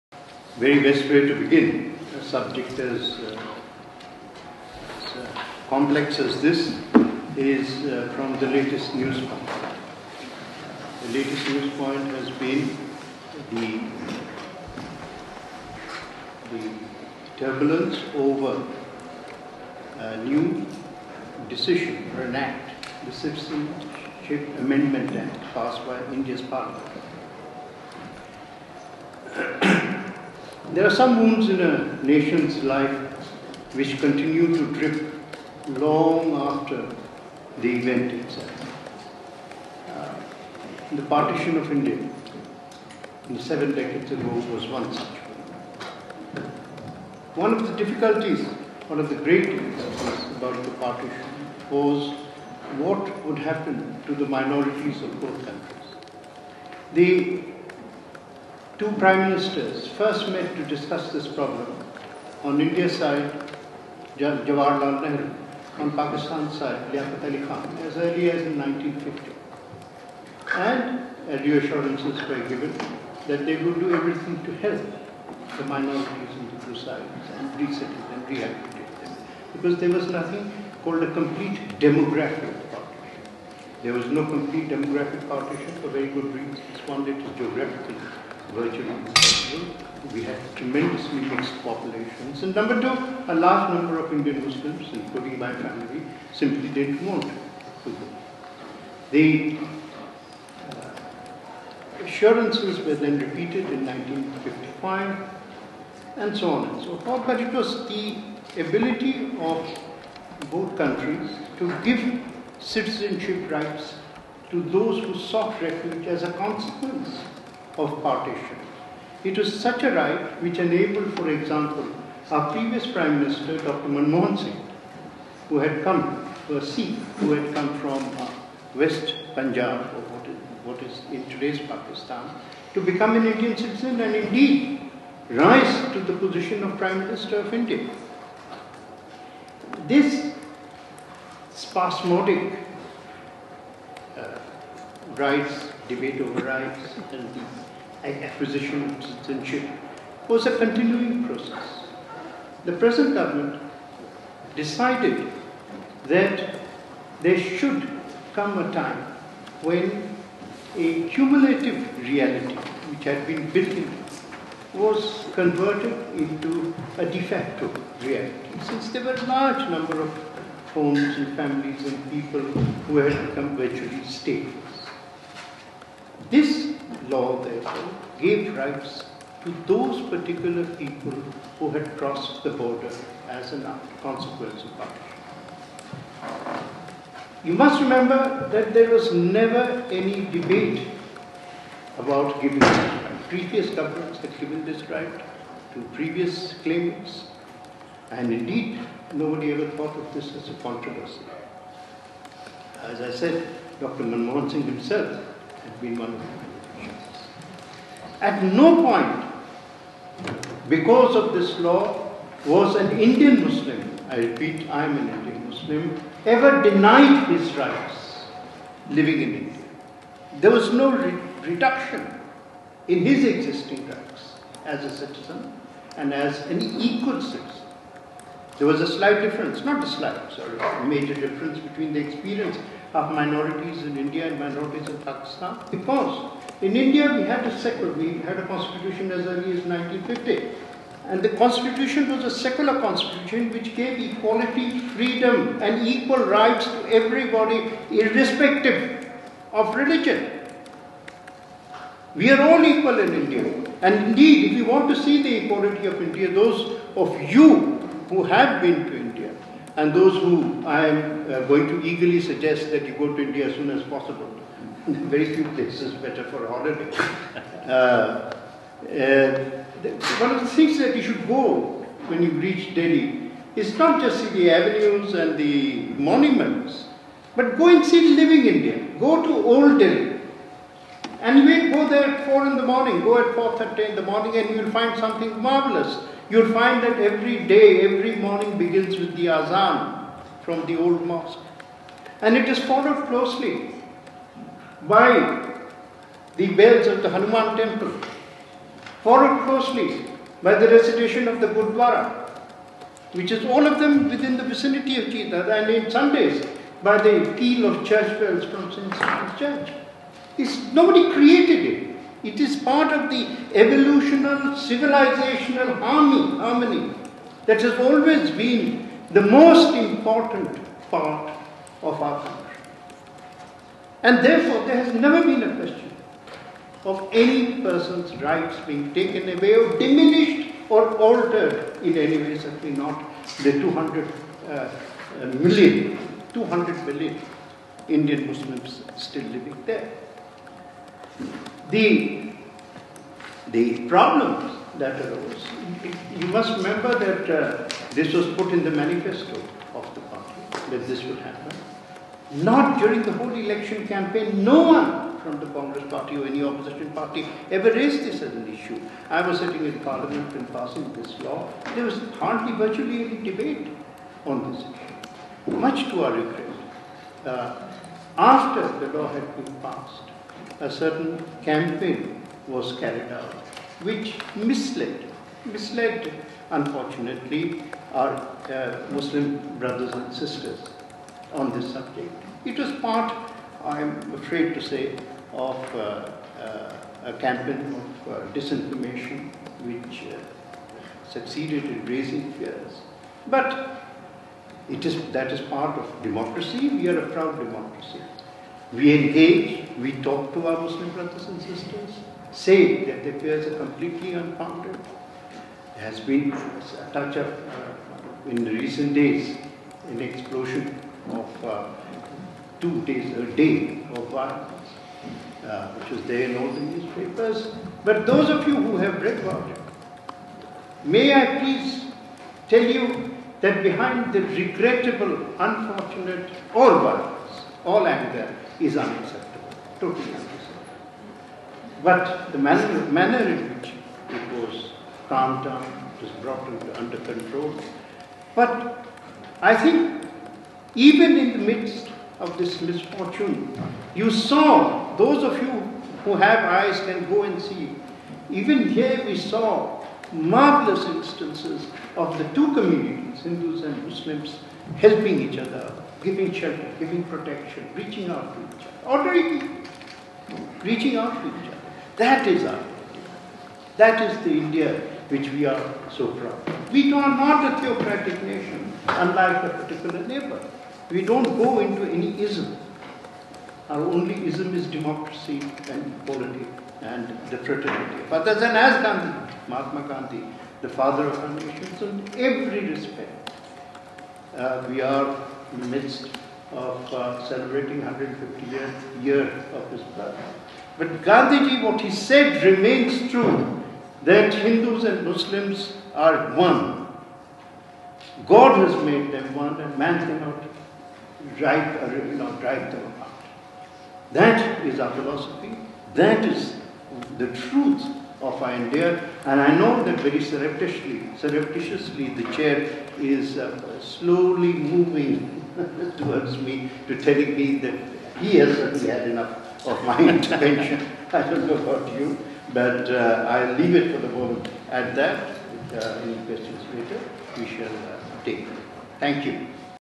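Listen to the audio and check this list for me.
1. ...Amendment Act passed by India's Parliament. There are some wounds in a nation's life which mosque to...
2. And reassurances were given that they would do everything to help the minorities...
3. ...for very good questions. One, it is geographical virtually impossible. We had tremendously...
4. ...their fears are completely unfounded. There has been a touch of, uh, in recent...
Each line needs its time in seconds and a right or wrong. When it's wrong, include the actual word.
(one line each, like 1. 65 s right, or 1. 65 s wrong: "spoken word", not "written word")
1. 24 s wrong: "continue", not "mosque"
2. 70 s right
3. 85 s wrong: "reasons", not "questions"
4. 403 s right.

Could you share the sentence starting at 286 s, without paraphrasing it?
You'll find that every day, every morning begins with the azan from the old mosque.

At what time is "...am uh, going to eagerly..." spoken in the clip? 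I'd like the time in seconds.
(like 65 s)
260 s.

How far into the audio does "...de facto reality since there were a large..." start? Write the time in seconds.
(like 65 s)
167 s.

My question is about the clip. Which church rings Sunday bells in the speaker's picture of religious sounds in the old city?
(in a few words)
St. Stephen's Church.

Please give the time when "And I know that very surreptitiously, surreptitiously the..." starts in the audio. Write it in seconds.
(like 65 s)
509 s.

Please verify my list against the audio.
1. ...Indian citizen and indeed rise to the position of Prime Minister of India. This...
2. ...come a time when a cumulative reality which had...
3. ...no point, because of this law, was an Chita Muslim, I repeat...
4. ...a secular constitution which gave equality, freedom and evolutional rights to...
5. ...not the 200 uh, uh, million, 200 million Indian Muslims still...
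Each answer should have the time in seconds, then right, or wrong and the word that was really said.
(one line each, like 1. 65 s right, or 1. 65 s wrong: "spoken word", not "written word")
1. 133 s right
2. 158 s right
3. 208 s wrong: "Indian", not "Chita"
4. 242 s wrong: "equal", not "evolutional"
5. 332 s right.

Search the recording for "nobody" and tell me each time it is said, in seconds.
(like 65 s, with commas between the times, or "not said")
199 s, 310 s.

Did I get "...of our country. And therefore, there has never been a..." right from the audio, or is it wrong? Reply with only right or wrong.
right.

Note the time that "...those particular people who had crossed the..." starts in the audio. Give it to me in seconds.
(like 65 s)
179 s.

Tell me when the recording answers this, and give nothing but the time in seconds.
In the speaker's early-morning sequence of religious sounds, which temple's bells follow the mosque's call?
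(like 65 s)
297 s.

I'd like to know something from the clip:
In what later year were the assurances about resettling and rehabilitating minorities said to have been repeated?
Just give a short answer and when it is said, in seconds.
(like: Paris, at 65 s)
1955, at 103 s.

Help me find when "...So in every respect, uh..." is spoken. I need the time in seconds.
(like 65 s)
481 s.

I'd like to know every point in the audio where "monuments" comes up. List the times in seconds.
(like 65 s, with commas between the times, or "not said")
276 s.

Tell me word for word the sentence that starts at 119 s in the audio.
It was such a right which enabled, for example, our previous Prime Minister, Dr.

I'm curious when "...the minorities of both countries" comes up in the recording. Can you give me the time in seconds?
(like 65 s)
54 s.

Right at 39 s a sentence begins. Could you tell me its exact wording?
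Uh, the partition of India in the seven decades ago was one such one.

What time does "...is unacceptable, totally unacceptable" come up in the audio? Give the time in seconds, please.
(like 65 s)
428 s.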